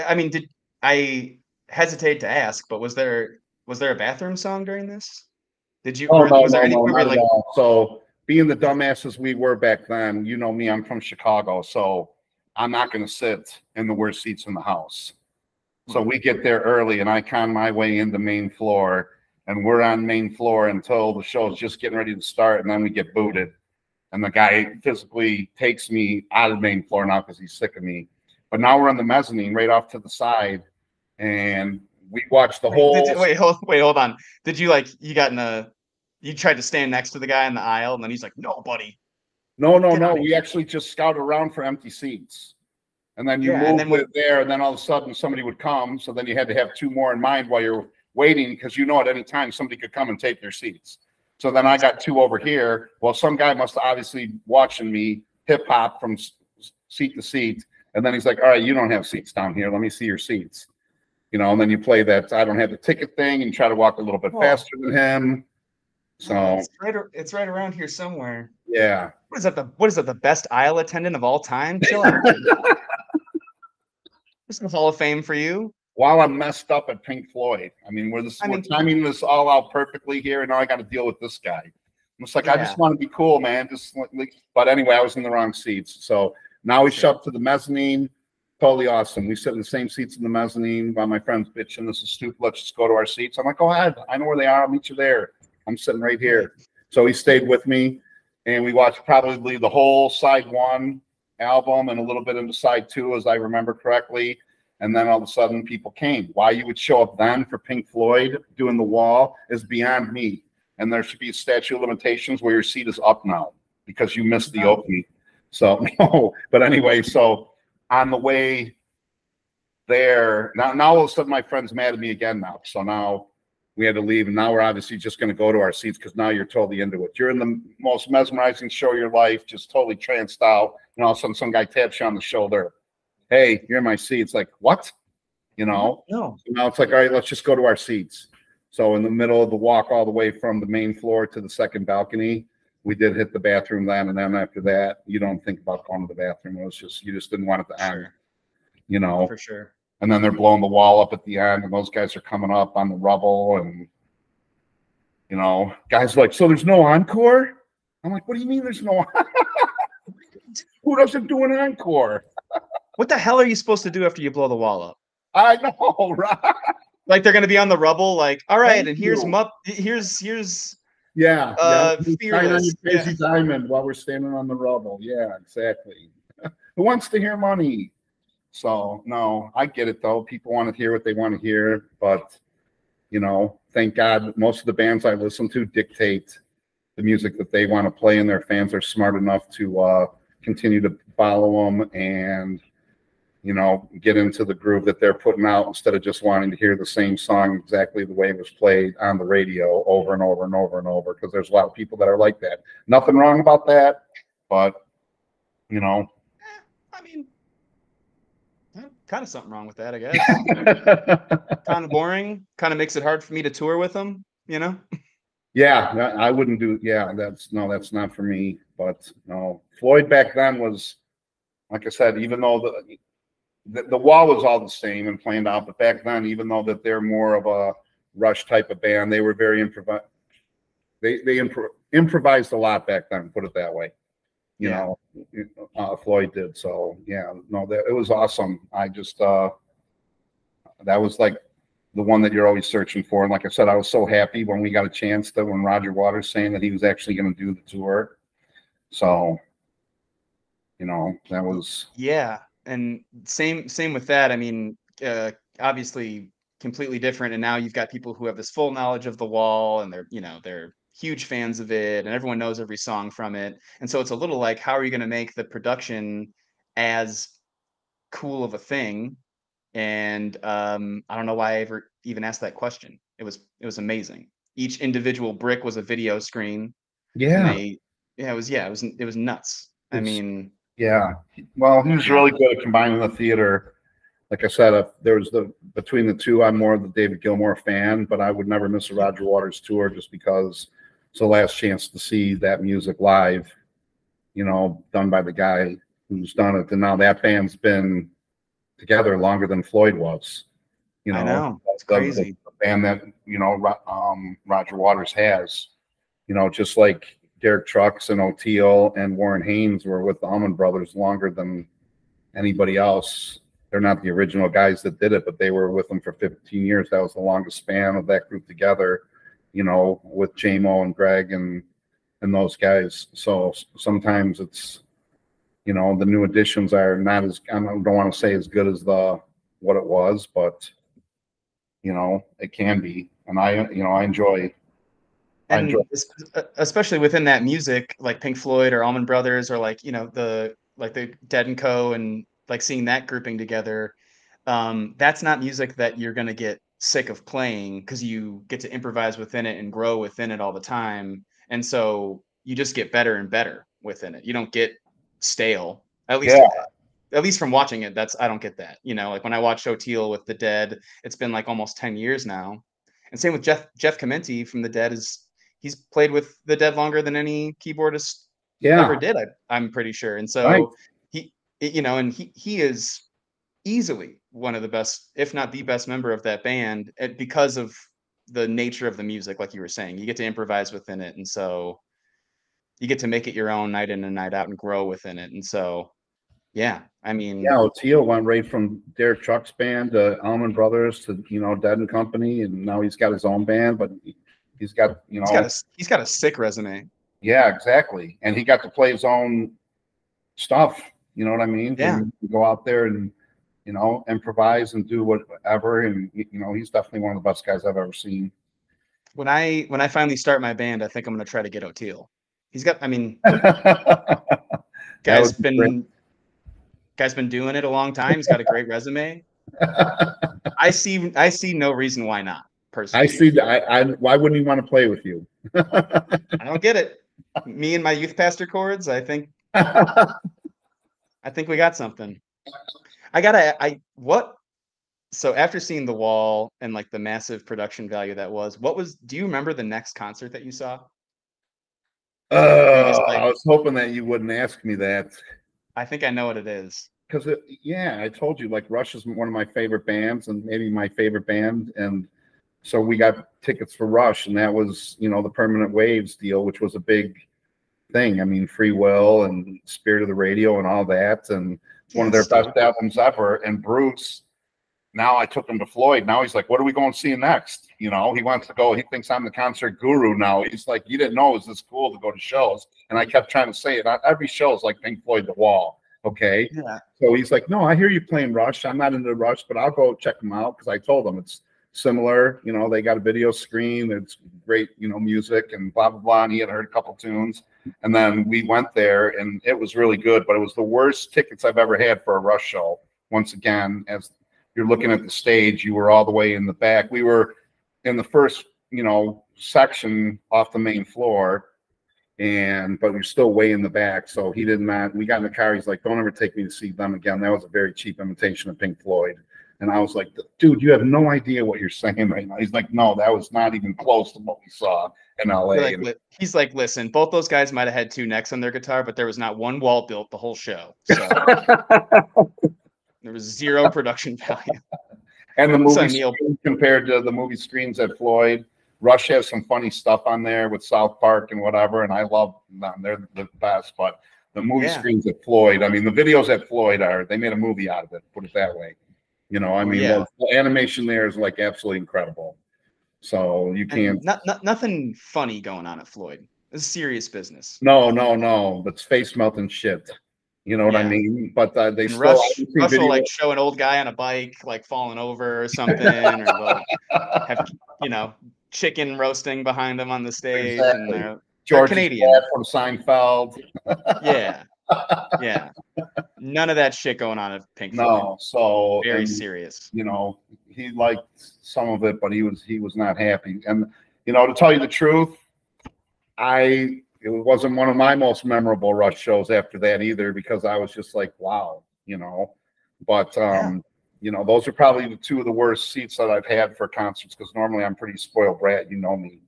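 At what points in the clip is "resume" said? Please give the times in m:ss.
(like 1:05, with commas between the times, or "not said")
6:36, 6:58.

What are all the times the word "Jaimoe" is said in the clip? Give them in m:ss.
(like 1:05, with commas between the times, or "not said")
5:20.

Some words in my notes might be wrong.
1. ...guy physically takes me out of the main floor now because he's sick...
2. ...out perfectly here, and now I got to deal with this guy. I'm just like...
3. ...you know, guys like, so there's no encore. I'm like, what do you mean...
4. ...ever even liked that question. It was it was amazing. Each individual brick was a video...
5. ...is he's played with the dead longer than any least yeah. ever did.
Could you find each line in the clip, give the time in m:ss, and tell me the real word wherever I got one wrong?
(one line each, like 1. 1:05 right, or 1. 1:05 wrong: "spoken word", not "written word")
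1. 0:24 right
2. 1:19 right
3. 2:35 right
4. 4:31 wrong: "asked", not "liked"
5. 6:04 wrong: "keyboardist", not "least".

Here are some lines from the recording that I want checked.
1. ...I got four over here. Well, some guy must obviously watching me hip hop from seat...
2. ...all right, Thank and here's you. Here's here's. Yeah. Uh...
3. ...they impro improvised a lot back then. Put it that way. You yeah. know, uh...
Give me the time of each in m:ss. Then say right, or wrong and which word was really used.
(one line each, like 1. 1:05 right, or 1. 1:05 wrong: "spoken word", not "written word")
1. 0:51 wrong: "two", not "four"
2. 2:48 right
3. 3:51 right.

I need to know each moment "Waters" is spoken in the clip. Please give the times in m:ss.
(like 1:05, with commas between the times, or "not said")
4:05, 4:49, 5:04.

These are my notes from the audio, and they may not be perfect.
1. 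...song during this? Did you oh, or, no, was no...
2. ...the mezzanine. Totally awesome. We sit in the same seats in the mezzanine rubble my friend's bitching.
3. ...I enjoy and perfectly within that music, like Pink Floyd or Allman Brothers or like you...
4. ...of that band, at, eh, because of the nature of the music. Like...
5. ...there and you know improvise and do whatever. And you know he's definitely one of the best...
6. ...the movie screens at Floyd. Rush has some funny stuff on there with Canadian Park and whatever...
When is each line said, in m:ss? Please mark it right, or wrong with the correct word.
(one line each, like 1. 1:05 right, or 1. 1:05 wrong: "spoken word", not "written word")
1. 0:04 right
2. 1:27 wrong: "while", not "rubble"
3. 5:33 wrong: "especially", not "perfectly"
4. 6:16 right
5. 6:42 right
6. 8:47 wrong: "South", not "Canadian".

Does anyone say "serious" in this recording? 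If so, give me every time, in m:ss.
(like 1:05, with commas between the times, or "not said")
9:06, 9:29.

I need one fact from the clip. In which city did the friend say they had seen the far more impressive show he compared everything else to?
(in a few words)
LA.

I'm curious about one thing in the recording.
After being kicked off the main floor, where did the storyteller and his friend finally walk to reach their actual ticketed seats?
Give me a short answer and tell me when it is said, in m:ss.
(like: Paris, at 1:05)
Second balcony, at 2:21.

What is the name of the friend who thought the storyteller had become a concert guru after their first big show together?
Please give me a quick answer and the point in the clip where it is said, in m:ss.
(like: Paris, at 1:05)
Bruce, at 7:43.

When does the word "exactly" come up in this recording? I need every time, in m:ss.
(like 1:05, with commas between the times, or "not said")
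2:55, 3:17, 6:37, 9:20.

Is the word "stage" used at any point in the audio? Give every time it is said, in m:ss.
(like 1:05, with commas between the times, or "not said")
8:15, 9:20.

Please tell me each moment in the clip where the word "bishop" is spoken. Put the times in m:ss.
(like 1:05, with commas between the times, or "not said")
not said.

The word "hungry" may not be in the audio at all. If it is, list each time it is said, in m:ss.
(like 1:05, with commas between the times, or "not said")
not said.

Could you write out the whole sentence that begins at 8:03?
It's great, you know, music and blah blah blah.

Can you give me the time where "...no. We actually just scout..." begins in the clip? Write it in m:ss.
0:39.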